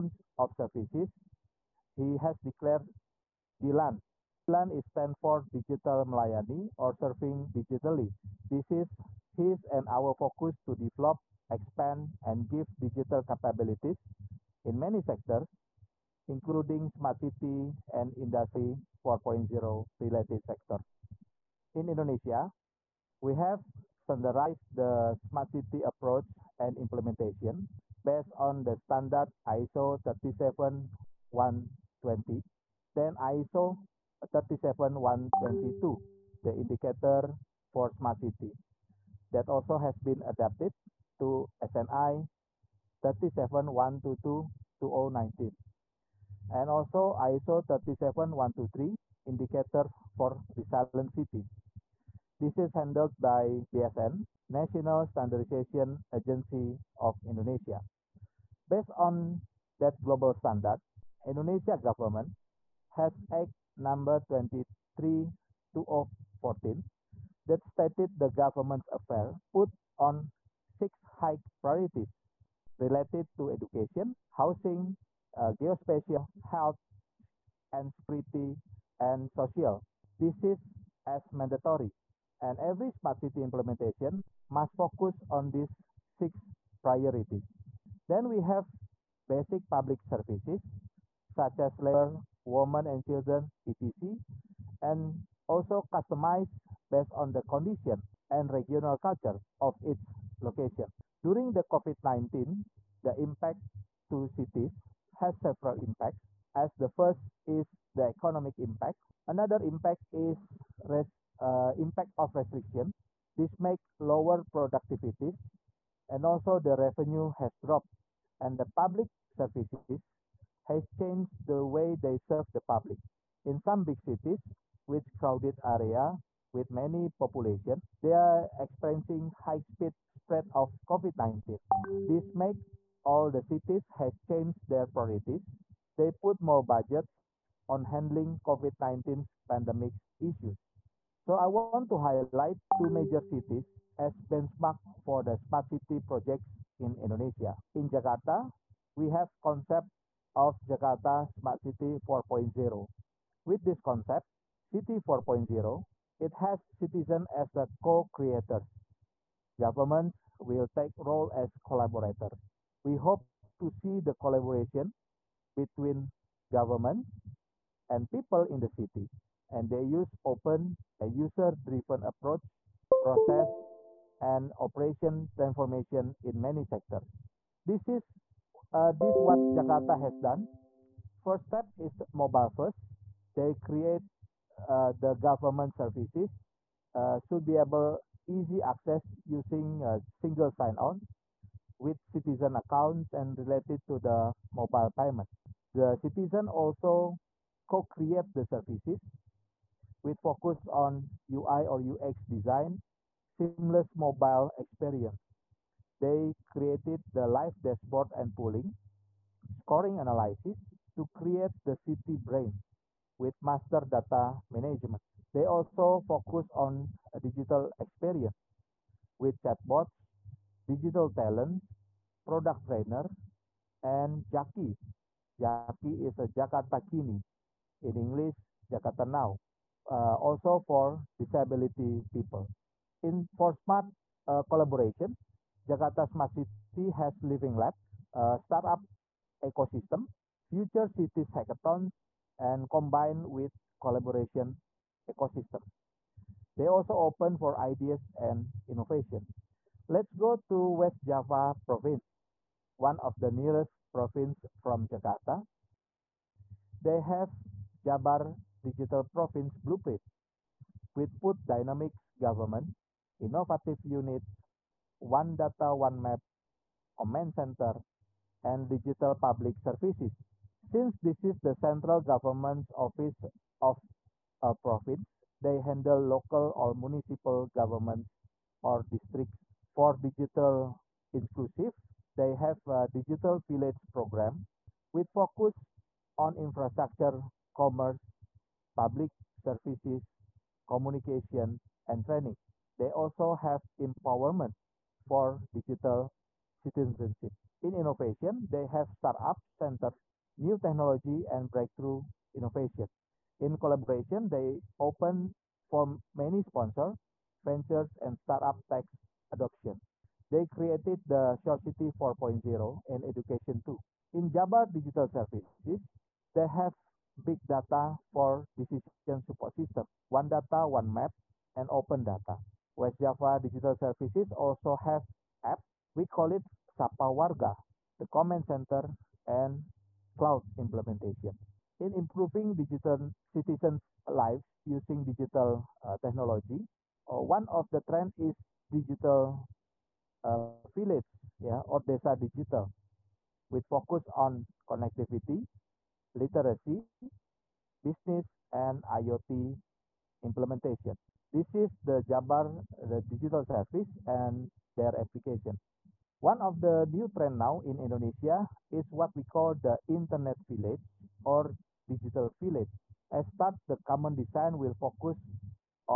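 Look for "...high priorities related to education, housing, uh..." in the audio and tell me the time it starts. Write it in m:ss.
1:11.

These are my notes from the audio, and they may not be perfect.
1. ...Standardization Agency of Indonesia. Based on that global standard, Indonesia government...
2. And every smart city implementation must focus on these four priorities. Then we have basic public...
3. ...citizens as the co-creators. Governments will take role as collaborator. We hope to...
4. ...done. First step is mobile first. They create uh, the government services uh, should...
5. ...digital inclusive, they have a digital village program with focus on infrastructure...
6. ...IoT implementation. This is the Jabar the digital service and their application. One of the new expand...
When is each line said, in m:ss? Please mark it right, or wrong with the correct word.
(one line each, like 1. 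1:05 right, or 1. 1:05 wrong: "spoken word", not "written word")
1. 0:55 right
2. 1:22 wrong: "six", not "four"
3. 2:36 right
4. 3:00 right
5. 4:39 right
6. 5:48 wrong: "trend", not "expand".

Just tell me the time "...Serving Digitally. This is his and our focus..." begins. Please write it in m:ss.
0:06.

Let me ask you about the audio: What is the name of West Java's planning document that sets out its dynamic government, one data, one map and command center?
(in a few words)
Jabar Digital Province Blueprint.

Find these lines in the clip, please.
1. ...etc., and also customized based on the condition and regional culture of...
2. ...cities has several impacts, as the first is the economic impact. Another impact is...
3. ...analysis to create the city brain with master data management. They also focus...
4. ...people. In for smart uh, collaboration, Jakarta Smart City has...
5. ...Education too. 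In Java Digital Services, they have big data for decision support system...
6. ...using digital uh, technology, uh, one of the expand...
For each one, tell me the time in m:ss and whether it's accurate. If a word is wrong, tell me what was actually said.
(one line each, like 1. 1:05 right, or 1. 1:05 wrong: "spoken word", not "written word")
1. 1:33 right
2. 1:44 right
3. 3:30 right
4. 3:52 right
5. 5:13 right
6. 5:34 wrong: "trend", not "expand".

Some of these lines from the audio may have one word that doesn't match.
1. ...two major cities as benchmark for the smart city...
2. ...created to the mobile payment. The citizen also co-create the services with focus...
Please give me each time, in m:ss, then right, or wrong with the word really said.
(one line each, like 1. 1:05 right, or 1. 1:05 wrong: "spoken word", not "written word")
1. 2:22 right
2. 3:13 wrong: "related", not "created".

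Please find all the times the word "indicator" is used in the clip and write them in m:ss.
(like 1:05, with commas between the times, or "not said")
0:36, 0:49.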